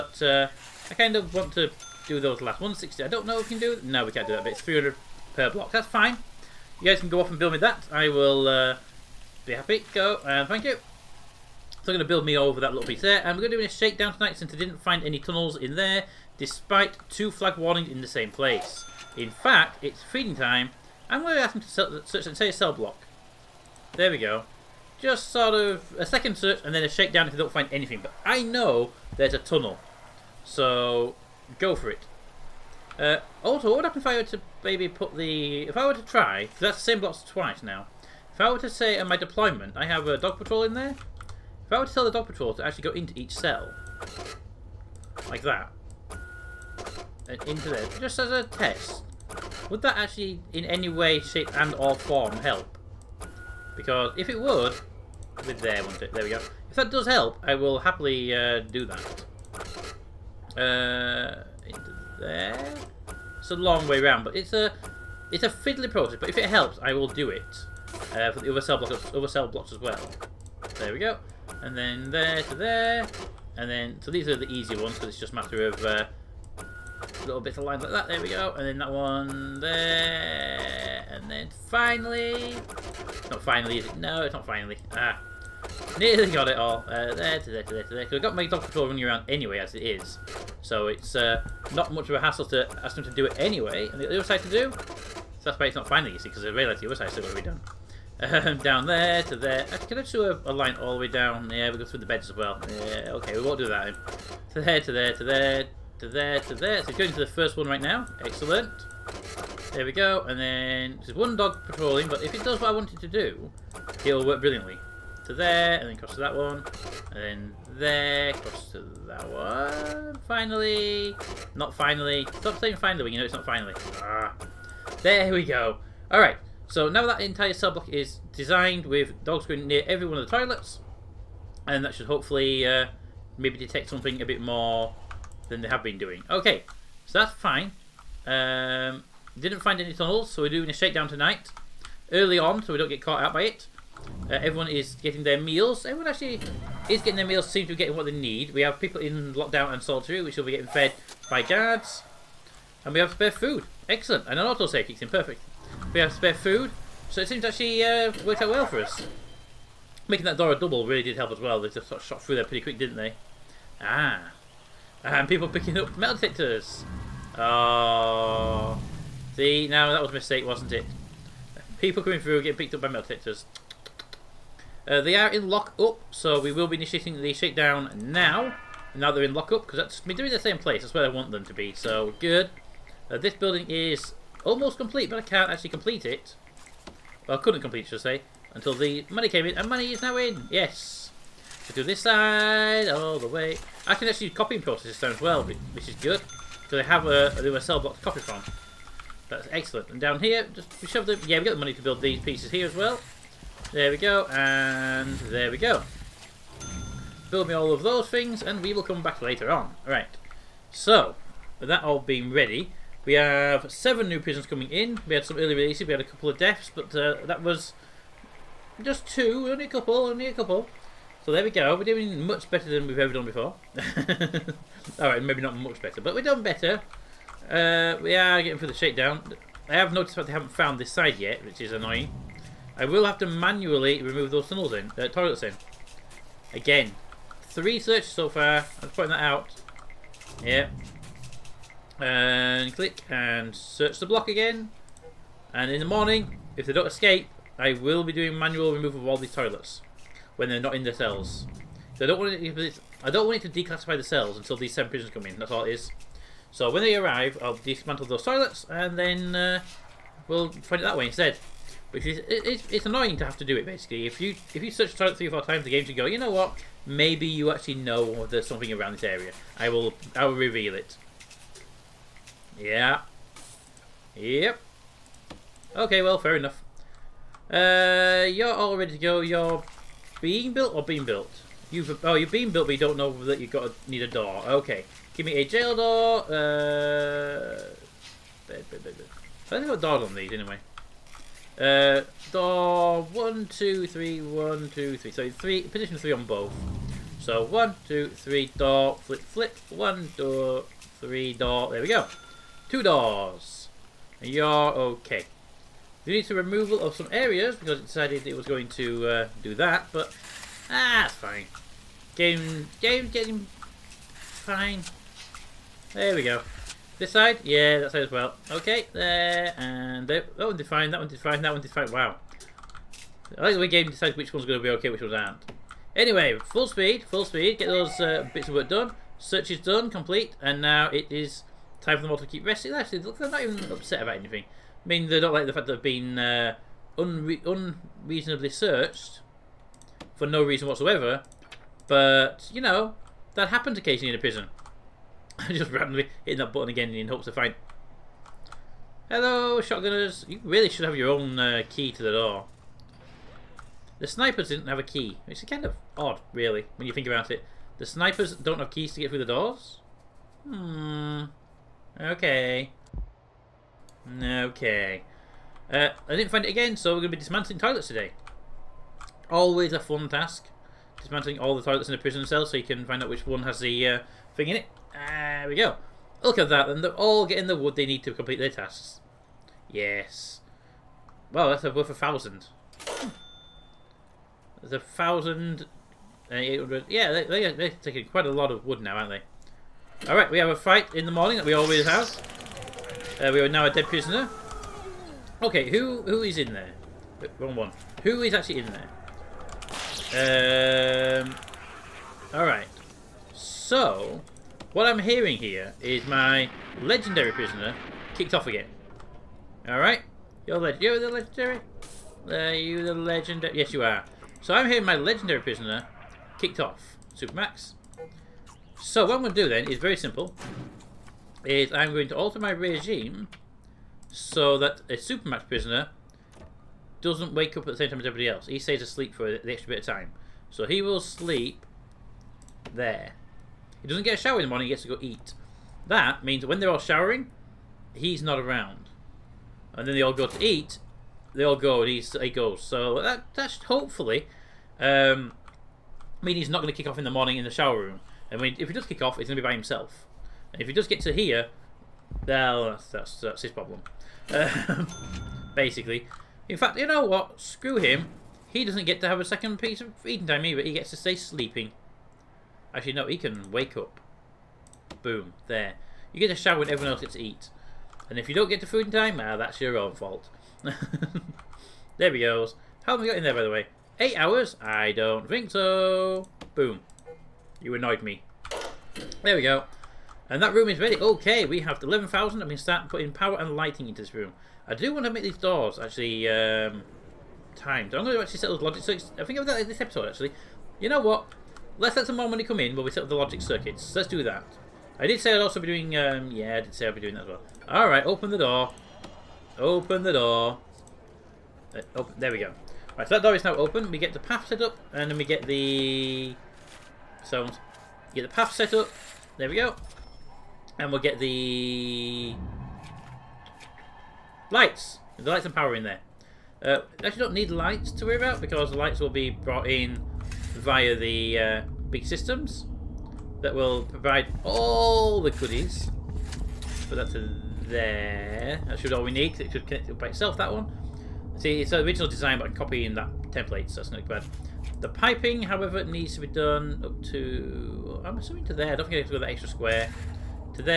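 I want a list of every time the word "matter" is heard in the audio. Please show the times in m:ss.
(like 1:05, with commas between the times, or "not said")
1:15.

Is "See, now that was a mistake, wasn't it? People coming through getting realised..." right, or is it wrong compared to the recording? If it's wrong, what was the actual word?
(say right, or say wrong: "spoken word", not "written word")
wrong: "picked", not "realised".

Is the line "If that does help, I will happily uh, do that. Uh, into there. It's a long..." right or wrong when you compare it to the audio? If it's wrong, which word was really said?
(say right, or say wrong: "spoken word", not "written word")
right.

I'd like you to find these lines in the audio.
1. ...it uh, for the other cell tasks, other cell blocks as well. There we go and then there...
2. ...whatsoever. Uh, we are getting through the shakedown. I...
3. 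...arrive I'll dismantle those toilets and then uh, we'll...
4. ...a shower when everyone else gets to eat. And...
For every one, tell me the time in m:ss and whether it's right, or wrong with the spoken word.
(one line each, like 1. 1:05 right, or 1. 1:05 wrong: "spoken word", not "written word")
1. 1:07 wrong: "blocks", not "tasks"
2. 3:46 wrong: "better", not "whatsoever"
3. 4:16 right
4. 7:46 right.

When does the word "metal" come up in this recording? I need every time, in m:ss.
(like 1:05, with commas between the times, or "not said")
2:45, 2:52.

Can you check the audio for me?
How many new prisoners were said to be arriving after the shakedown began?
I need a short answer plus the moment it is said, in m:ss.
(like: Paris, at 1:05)
7, at 3:33.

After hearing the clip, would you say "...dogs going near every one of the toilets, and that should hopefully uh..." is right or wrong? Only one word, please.
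right.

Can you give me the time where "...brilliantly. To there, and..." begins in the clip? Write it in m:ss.
1:54.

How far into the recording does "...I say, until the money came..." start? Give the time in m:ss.
3:08.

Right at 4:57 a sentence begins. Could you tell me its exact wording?
So one, two, three, door, flip, flip.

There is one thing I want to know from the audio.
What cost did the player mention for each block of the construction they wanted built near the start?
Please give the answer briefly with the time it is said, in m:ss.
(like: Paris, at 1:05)
300, at 0:04.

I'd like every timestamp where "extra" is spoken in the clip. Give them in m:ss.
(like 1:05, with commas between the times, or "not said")
7:09, 8:59.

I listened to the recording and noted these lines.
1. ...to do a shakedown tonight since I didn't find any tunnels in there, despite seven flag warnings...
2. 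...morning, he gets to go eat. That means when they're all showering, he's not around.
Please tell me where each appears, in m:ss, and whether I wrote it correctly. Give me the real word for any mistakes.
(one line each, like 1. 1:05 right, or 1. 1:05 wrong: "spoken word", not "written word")
1. 0:13 wrong: "two", not "seven"
2. 7:14 right.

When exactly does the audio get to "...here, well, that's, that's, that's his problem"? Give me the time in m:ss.
7:31.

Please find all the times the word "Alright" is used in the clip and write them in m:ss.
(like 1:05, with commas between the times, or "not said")
6:30, 6:42, 6:49, 8:17.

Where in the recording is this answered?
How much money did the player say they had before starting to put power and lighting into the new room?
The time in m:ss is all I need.
8:01.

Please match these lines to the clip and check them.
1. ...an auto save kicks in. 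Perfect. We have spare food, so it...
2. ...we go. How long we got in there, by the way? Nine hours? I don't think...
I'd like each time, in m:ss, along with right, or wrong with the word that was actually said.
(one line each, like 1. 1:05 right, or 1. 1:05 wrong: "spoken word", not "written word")
1. 2:34 right
2. 7:52 wrong: "Eight", not "Nine".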